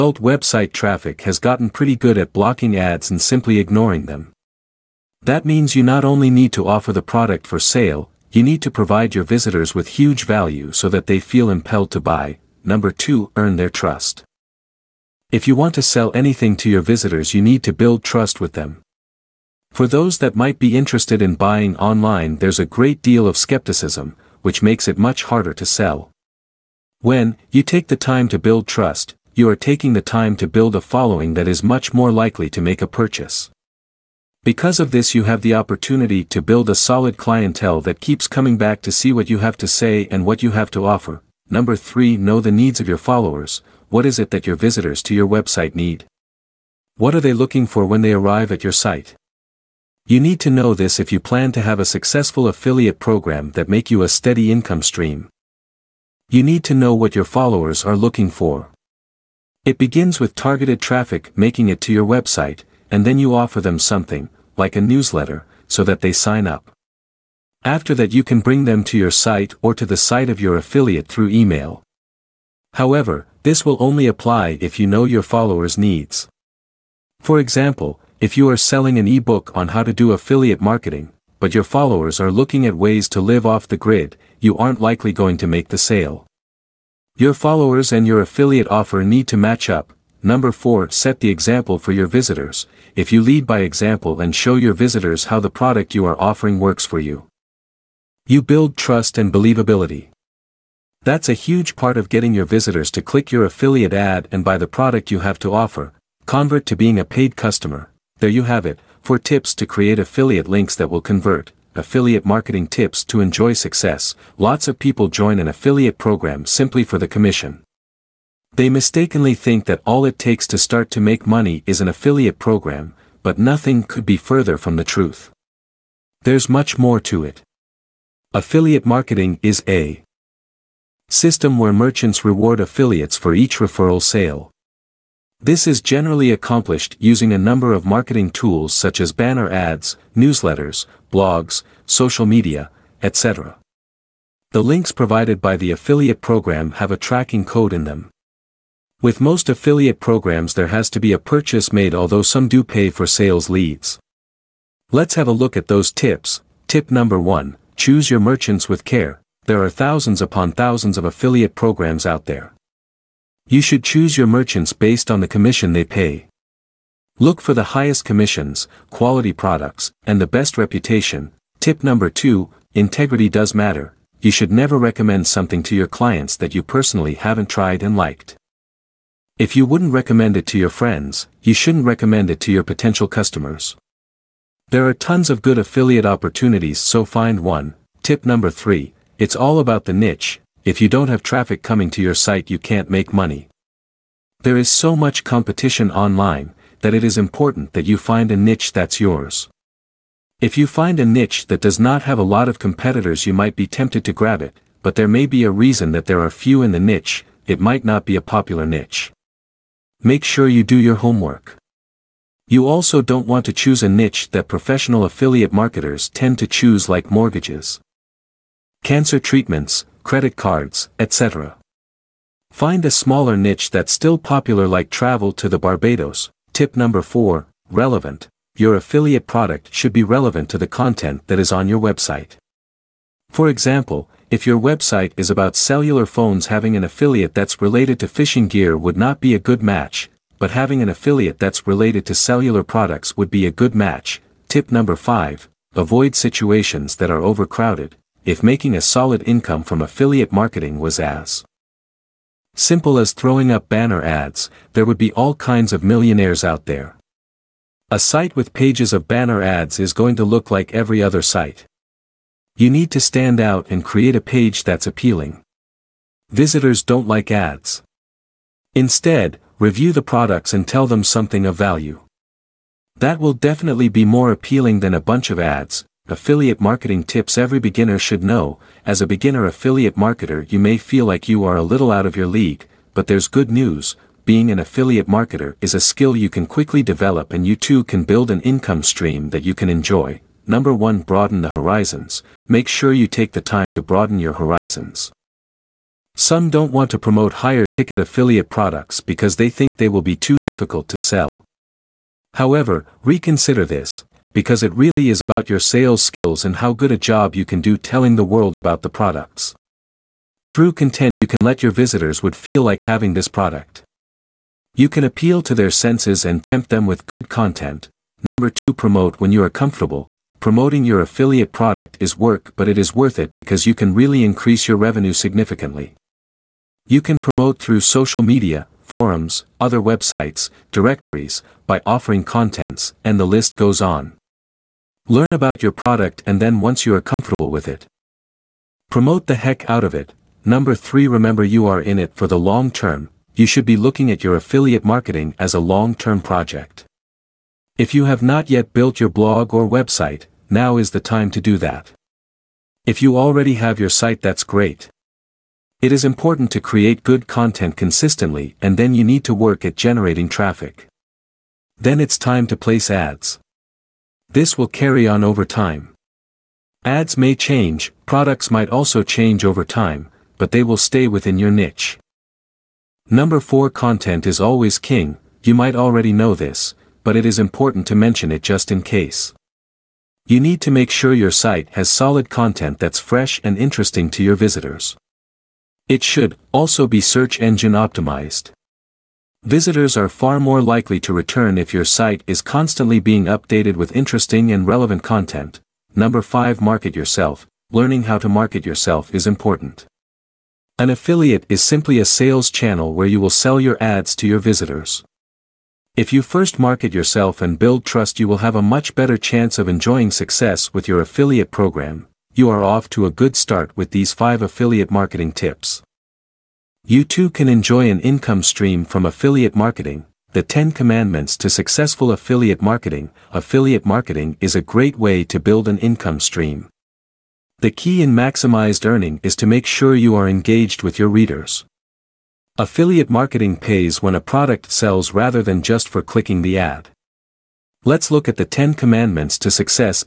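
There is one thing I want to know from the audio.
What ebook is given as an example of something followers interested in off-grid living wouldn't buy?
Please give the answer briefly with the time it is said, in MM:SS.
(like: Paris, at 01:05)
How to do affiliate marketing, at 01:19.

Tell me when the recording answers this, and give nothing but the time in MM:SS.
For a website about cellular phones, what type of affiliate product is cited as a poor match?
03:58.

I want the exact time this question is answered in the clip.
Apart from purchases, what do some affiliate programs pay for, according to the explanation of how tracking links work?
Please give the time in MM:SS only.
02:33.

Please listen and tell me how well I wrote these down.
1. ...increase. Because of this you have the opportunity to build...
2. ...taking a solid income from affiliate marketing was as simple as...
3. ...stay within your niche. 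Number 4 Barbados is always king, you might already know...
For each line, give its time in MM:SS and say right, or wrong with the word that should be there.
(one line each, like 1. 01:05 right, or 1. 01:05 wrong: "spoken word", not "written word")
1. 00:32 wrong: "purchase", not "increase"
2. 04:08 wrong: "making", not "taking"
3. 06:10 wrong: "Content", not "Barbados".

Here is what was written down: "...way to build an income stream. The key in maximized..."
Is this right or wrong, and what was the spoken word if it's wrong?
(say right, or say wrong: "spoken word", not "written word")
right.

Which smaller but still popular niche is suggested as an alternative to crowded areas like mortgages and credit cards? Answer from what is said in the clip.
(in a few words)
Travel to the Barbados.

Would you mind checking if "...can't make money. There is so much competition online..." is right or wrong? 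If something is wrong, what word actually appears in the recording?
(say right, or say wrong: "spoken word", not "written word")
right.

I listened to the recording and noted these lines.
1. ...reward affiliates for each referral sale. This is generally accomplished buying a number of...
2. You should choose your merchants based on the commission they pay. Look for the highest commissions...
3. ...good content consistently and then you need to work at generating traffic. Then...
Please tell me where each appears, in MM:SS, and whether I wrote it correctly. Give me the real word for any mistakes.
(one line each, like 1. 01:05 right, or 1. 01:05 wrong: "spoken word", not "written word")
1. 02:12 wrong: "using", not "buying"
2. 02:43 right
3. 05:57 right.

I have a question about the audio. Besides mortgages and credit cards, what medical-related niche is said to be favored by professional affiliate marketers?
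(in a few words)
Cancer treatments.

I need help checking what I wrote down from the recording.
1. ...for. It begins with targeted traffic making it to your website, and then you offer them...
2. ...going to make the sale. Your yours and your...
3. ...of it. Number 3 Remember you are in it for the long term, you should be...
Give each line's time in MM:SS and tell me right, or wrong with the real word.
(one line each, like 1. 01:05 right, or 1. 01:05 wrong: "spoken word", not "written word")
1. 00:58 right
2. 01:25 wrong: "followers", not "yours"
3. 05:39 right.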